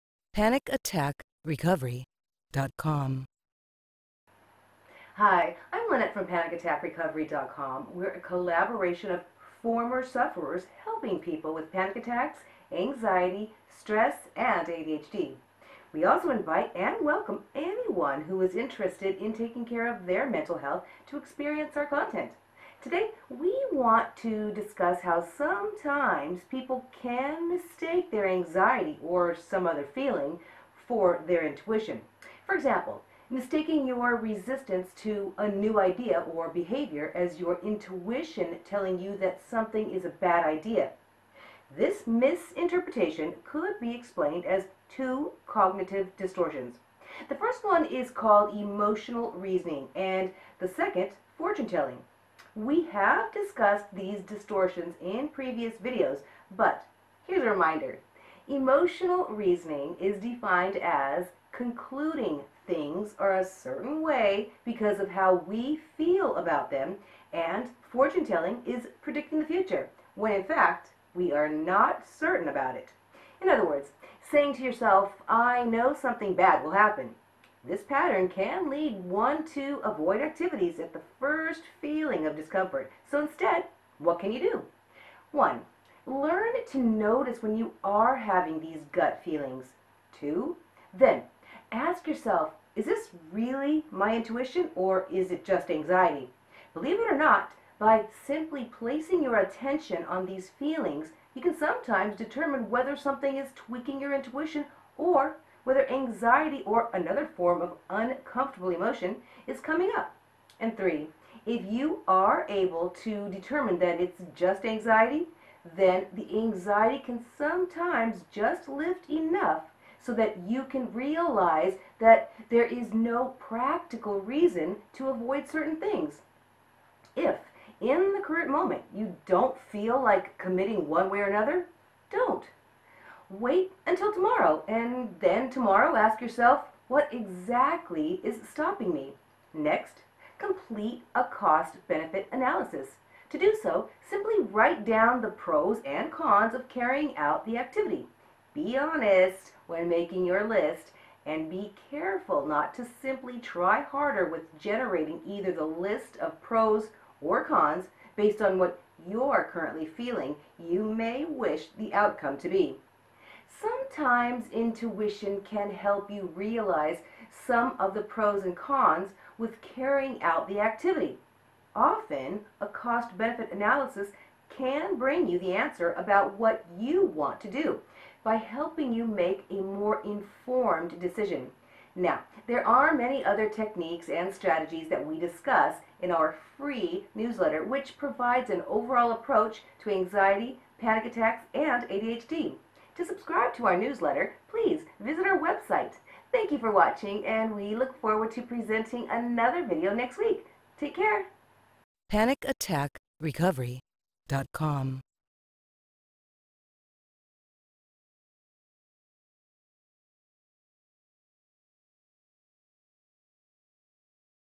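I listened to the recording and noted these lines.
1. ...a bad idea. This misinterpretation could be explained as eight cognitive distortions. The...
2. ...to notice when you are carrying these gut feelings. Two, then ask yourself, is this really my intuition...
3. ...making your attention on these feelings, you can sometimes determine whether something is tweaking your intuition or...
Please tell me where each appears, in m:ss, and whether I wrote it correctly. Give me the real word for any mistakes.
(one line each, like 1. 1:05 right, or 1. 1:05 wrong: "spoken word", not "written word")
1. 0:40 wrong: "two", not "eight"
2. 1:26 wrong: "having", not "carrying"
3. 1:38 wrong: "placing", not "making".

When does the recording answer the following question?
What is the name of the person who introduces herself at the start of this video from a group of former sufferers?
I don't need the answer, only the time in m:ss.
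0:05.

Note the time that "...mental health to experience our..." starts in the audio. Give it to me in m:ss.
0:20.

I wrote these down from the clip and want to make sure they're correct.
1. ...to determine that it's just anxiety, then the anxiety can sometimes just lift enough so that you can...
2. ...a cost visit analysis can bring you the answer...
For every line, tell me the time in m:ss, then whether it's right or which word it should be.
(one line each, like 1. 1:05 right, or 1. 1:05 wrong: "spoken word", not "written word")
1. 1:53 right
2. 2:52 wrong: "benefit", not "visit".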